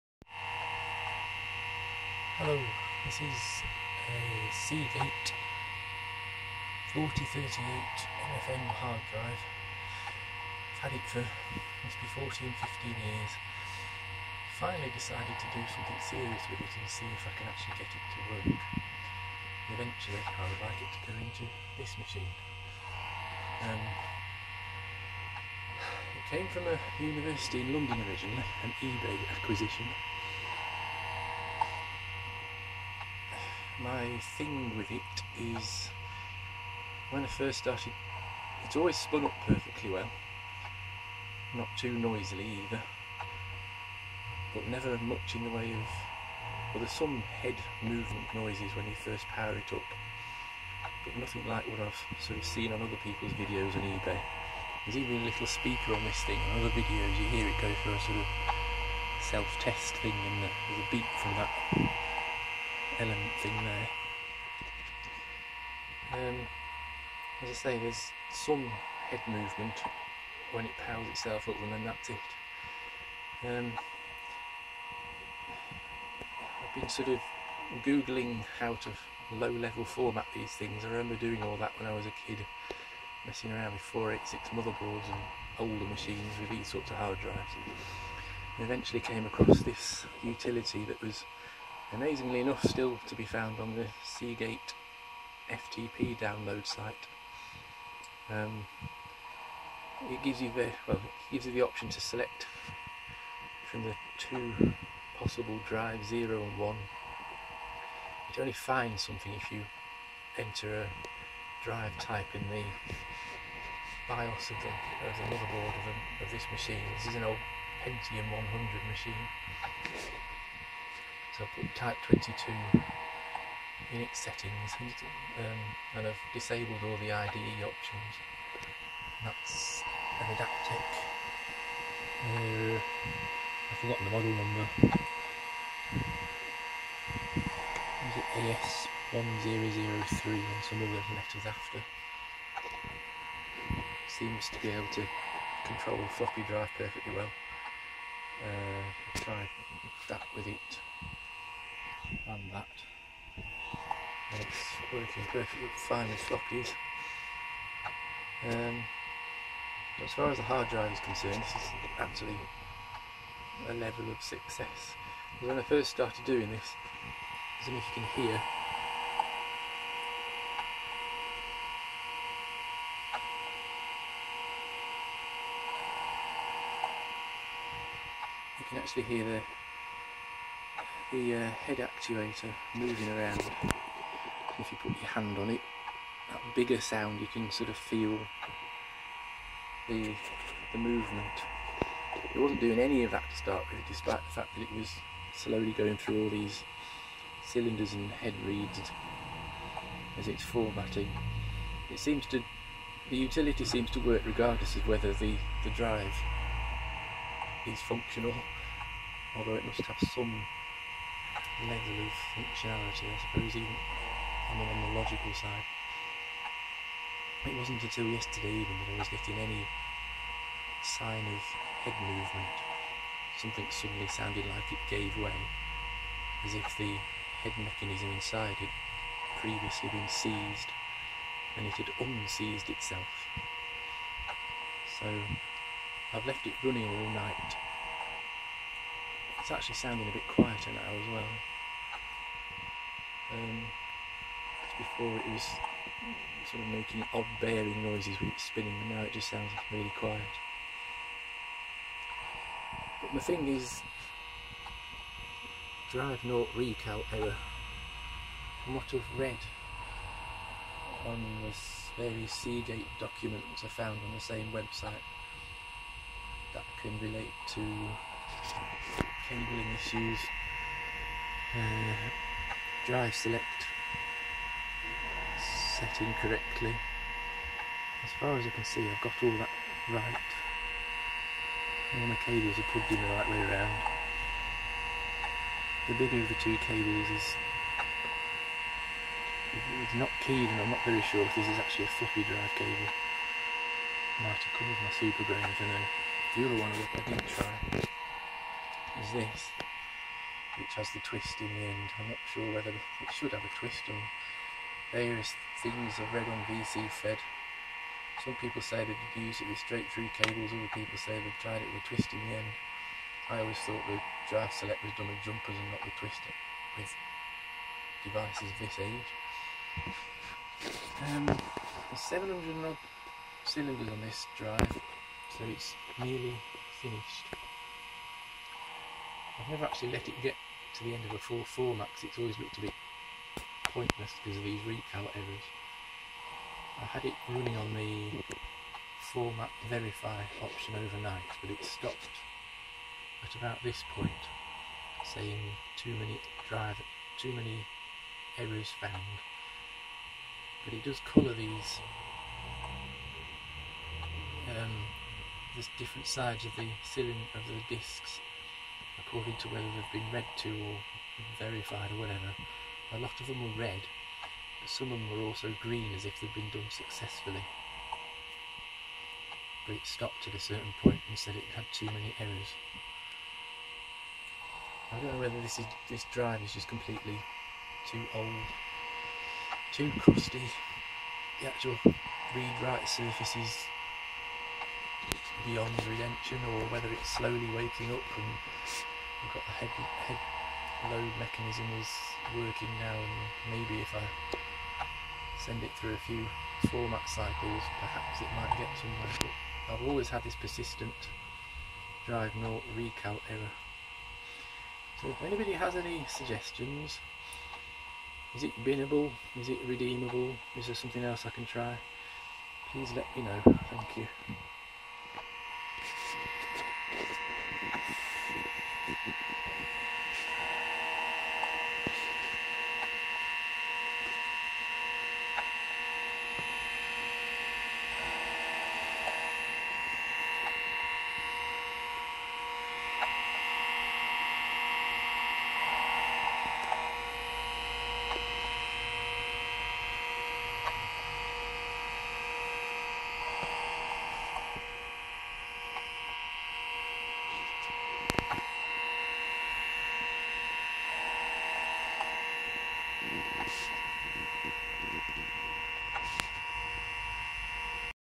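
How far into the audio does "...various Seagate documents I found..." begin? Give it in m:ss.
4:21.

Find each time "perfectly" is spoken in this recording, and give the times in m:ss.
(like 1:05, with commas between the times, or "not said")
0:39, 2:26, 2:35.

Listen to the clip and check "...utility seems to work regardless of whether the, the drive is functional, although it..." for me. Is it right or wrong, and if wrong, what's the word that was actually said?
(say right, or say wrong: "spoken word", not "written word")
right.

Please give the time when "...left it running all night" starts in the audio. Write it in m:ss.
3:56.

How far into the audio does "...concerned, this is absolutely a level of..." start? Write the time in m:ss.
2:41.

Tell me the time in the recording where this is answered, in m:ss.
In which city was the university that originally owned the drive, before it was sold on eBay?
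0:27.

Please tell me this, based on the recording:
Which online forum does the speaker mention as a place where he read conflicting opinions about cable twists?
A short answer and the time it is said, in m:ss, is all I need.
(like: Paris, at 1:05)
VCFed, at 5:06.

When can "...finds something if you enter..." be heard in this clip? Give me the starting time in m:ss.
1:48.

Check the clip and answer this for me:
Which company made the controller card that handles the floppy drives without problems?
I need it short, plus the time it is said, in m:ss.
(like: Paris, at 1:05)
Adaptec, at 2:10.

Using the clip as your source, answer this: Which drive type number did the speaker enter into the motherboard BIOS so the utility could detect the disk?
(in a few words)
22.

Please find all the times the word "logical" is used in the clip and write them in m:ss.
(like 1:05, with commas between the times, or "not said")
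3:34.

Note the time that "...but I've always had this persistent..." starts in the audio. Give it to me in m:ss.
6:39.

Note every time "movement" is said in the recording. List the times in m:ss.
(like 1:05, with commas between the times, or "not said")
0:47, 1:09, 3:10, 3:42.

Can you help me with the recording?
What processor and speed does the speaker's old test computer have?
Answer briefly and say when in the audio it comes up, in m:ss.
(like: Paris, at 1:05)
Pentium 100, at 1:57.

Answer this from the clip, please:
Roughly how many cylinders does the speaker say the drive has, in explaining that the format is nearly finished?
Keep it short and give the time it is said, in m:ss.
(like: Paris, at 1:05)
700, at 5:22.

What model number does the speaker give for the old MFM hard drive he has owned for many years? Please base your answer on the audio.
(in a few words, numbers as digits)
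Seagate 4038.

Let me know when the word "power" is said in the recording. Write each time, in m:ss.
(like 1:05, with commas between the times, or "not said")
0:49, 1:10.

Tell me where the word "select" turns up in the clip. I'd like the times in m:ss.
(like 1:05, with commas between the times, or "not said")
1:42, 4:33, 5:14.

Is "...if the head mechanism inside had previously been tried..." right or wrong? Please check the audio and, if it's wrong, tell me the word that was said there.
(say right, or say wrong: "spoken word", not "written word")
wrong: "seized", not "tried".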